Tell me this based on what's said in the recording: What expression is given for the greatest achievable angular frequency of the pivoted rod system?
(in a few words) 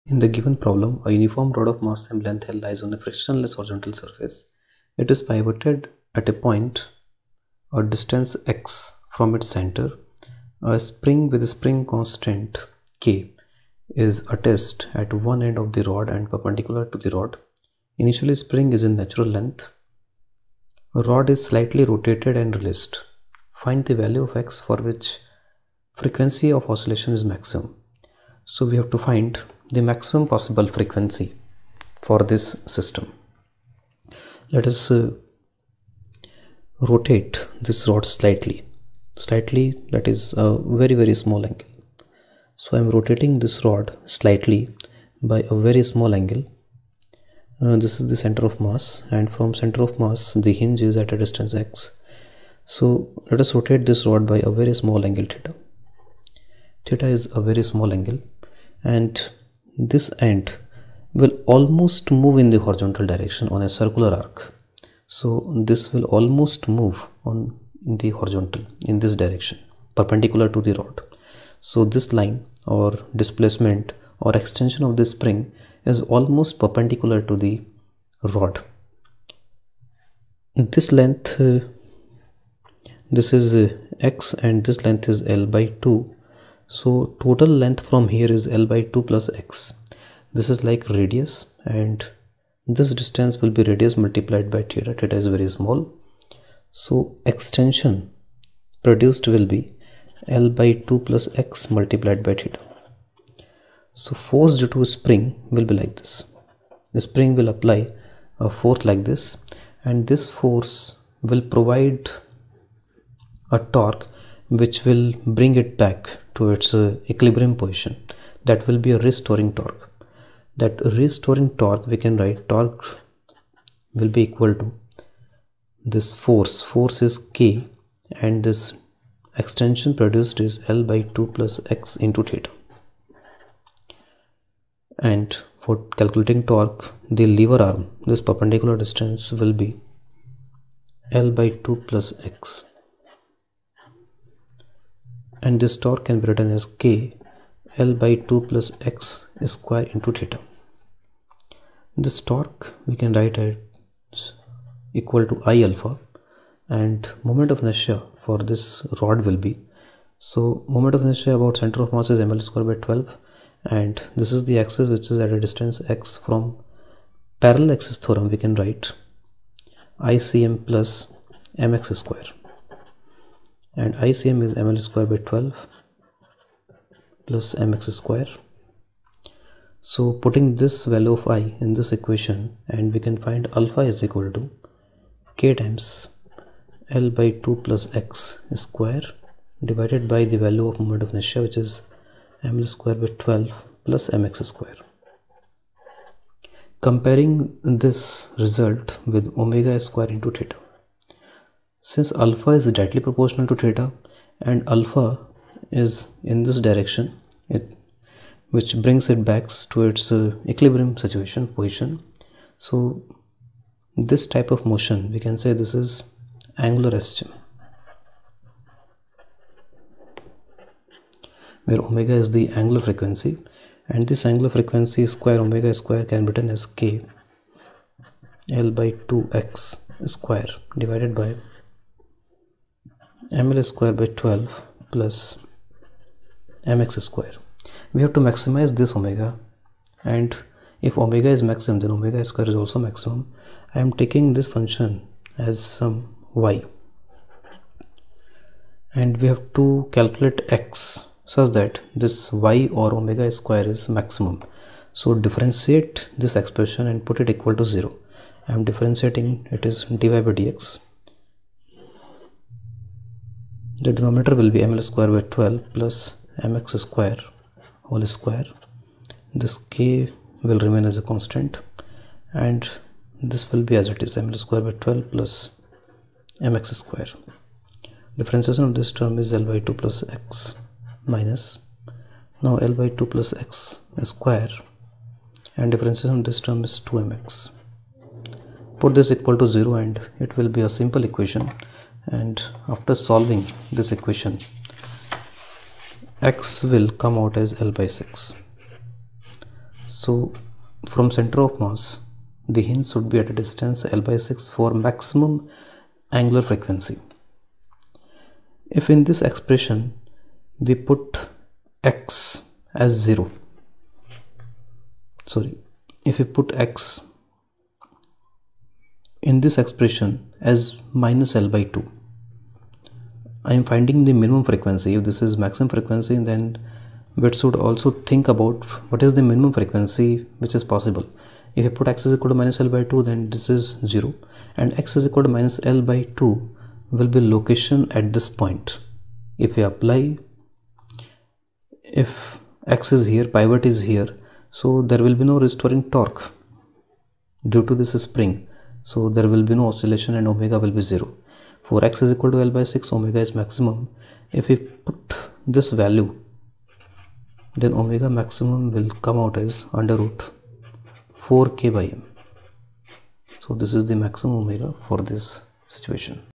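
√(4k/m).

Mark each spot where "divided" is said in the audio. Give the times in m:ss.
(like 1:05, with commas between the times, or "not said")
3:09, 3:50.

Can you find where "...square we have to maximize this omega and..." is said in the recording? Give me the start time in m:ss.
3:57.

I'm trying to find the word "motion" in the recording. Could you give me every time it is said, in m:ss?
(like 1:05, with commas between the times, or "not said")
3:34.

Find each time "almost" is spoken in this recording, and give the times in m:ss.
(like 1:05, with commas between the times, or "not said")
1:01, 1:06, 1:16.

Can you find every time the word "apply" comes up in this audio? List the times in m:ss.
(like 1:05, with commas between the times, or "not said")
1:47, 5:39.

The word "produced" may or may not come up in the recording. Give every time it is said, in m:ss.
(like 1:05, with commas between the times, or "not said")
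1:38, 2:10.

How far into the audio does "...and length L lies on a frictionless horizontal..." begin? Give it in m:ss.
0:02.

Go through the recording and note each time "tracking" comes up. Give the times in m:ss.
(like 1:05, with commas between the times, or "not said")
not said.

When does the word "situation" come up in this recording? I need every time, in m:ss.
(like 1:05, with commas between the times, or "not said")
3:30, 6:05.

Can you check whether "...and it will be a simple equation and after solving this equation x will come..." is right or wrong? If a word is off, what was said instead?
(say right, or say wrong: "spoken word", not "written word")
right.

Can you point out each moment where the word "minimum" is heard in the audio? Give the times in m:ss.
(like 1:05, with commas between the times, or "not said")
5:24, 5:29.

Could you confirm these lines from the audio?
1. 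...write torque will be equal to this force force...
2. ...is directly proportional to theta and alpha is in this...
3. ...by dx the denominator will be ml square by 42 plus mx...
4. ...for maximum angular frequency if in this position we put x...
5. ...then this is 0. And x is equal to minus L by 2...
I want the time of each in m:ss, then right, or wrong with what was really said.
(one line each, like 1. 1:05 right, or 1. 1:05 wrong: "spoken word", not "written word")
1. 2:02 right
2. 3:22 right
3. 4:20 wrong: "12", not "42"
4. 5:04 wrong: "expression", not "position"
5. 5:33 right.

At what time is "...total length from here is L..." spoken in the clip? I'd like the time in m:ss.
1:27.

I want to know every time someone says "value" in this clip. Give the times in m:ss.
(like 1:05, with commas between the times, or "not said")
0:23, 3:00, 3:10, 5:55.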